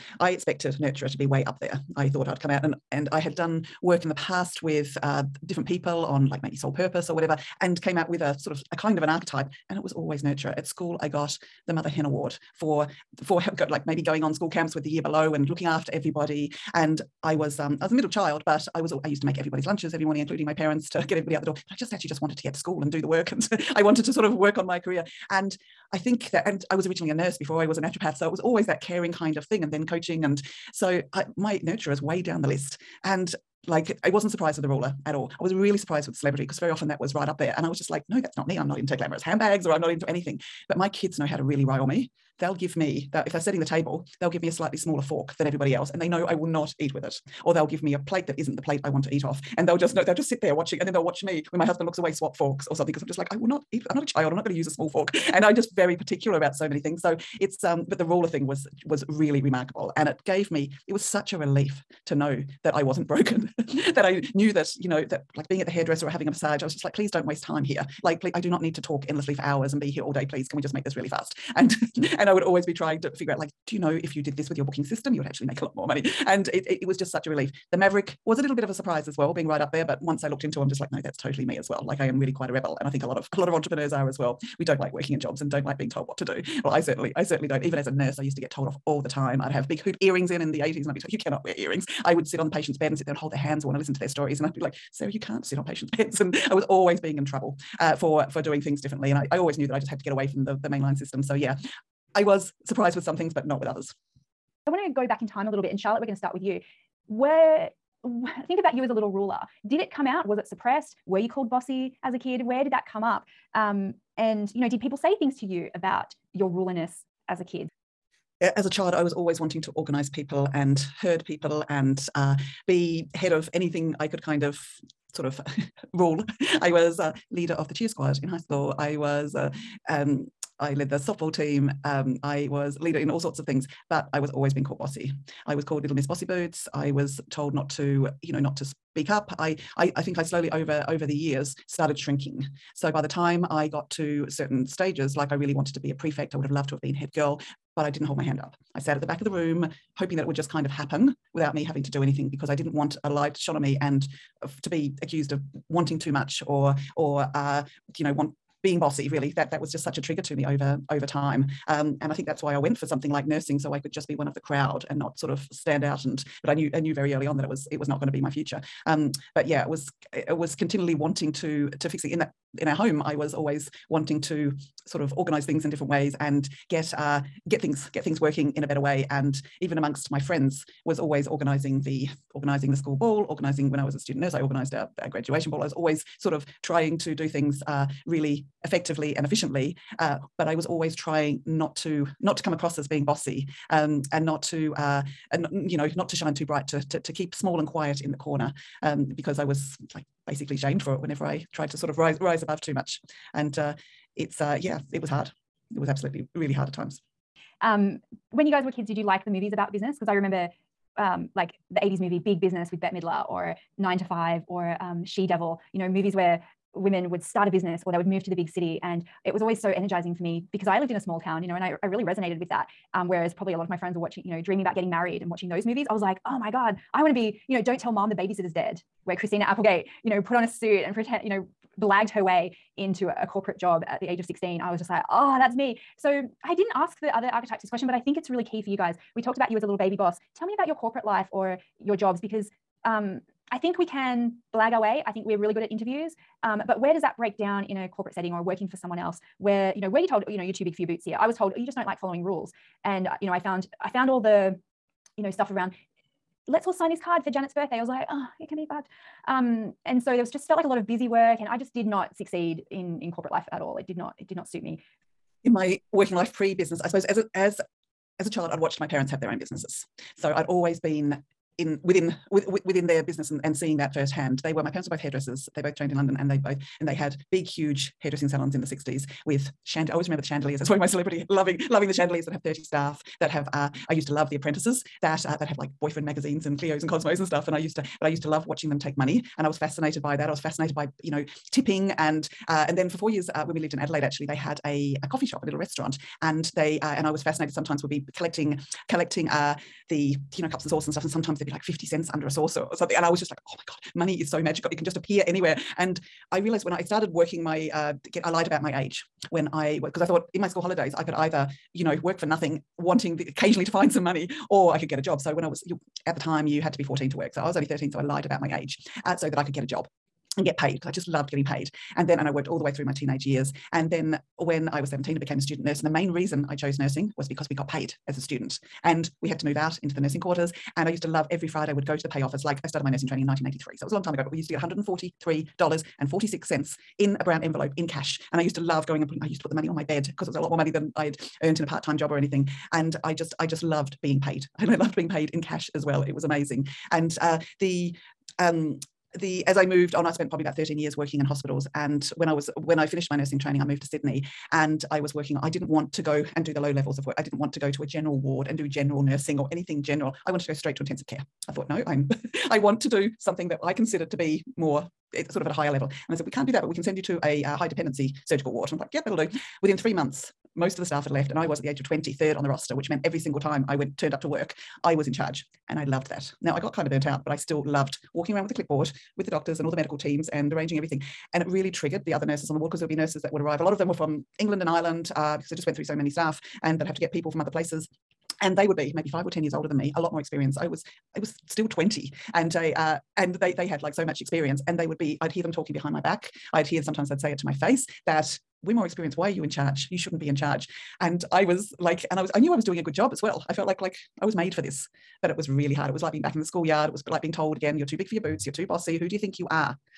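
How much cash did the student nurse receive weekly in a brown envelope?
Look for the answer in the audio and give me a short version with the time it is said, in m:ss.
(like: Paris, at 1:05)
$143.46, at 5:34.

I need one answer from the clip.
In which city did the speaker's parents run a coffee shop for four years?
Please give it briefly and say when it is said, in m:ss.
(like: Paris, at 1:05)
Adelaide, at 4:53.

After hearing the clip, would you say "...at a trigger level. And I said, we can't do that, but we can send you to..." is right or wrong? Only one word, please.
wrong.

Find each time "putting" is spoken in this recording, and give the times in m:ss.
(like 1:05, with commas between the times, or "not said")
5:39.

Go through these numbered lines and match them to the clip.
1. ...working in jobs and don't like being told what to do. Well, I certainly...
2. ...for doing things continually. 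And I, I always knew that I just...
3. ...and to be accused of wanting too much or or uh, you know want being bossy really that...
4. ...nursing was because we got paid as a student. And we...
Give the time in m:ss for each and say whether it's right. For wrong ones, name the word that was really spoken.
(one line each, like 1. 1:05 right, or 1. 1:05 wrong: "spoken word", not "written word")
1. 1:24 right
2. 1:38 wrong: "differently", not "continually"
3. 2:33 right
4. 5:26 right.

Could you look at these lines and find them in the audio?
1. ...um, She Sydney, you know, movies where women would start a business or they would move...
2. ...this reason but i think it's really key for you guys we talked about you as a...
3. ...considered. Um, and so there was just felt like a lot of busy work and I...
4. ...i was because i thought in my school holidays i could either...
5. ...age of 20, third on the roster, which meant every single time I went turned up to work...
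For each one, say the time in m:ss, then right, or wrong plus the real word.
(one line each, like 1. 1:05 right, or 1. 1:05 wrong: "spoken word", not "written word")
1. 3:34 wrong: "Devil", not "Sydney"
2. 3:57 wrong: "question", not "reason"
3. 4:18 wrong: "fucked", not "considered"
4. 5:09 right
5. 6:11 right.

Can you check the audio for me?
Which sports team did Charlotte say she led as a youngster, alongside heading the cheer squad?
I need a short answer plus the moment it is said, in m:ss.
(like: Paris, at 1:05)
softball team, at 2:10.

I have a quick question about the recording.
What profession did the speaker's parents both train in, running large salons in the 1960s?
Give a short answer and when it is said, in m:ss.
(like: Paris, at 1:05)
hairdressers, at 4:34.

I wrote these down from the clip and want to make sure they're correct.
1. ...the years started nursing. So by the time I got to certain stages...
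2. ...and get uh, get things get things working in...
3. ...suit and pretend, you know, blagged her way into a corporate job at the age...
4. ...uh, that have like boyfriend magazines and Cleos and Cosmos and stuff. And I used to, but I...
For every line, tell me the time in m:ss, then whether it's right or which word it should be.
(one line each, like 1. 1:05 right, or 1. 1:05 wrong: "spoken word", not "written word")
1. 2:21 wrong: "shrinking", not "nursing"
2. 2:56 right
3. 3:50 right
4. 4:45 right.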